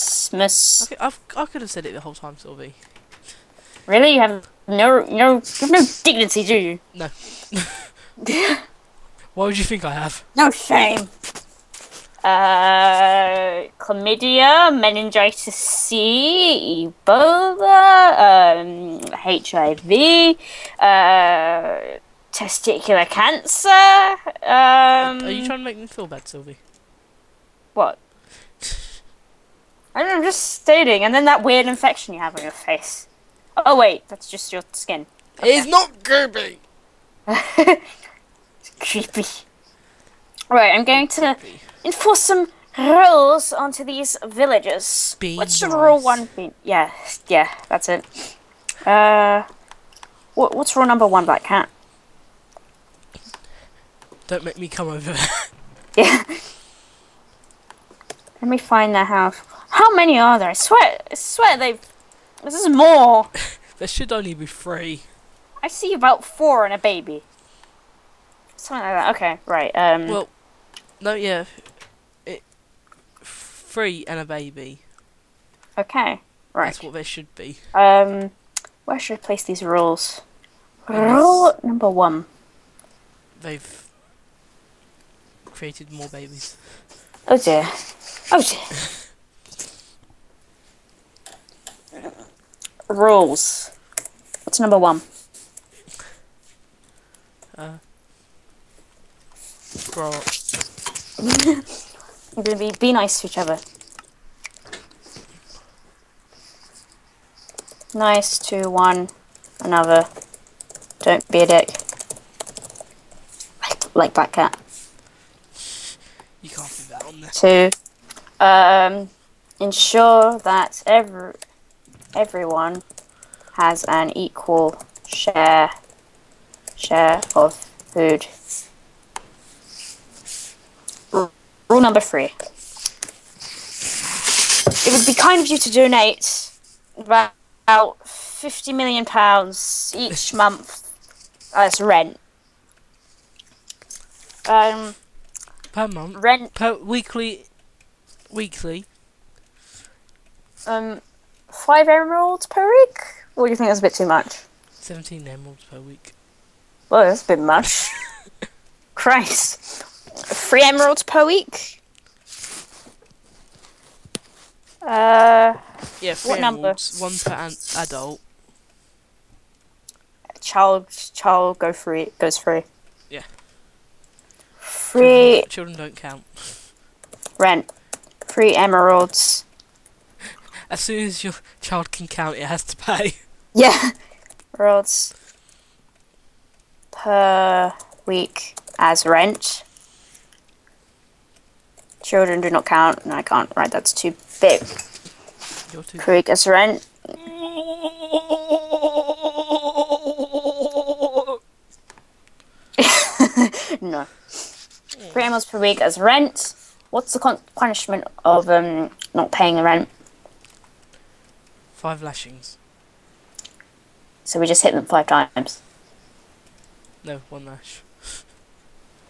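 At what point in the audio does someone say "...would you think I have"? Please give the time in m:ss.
0:09.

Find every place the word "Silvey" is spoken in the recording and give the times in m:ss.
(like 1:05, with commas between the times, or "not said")
0:02, 0:26.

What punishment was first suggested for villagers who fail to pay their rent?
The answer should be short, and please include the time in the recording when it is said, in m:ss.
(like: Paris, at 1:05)
5 lashings, at 3:31.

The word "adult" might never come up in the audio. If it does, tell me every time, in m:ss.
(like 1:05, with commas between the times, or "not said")
2:47.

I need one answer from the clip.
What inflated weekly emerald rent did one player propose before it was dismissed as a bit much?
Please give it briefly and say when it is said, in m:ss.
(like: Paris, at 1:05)
17 emeralds, at 2:34.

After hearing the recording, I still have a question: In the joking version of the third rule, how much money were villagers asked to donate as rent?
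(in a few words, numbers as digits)
50 million pounds.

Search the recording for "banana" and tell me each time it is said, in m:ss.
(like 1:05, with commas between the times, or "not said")
not said.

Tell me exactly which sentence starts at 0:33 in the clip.
Oh wait, that's just your skin.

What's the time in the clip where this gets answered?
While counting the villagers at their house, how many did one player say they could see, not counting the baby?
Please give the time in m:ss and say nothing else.
1:06.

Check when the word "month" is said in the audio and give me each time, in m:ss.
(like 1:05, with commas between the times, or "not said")
2:20, 2:25.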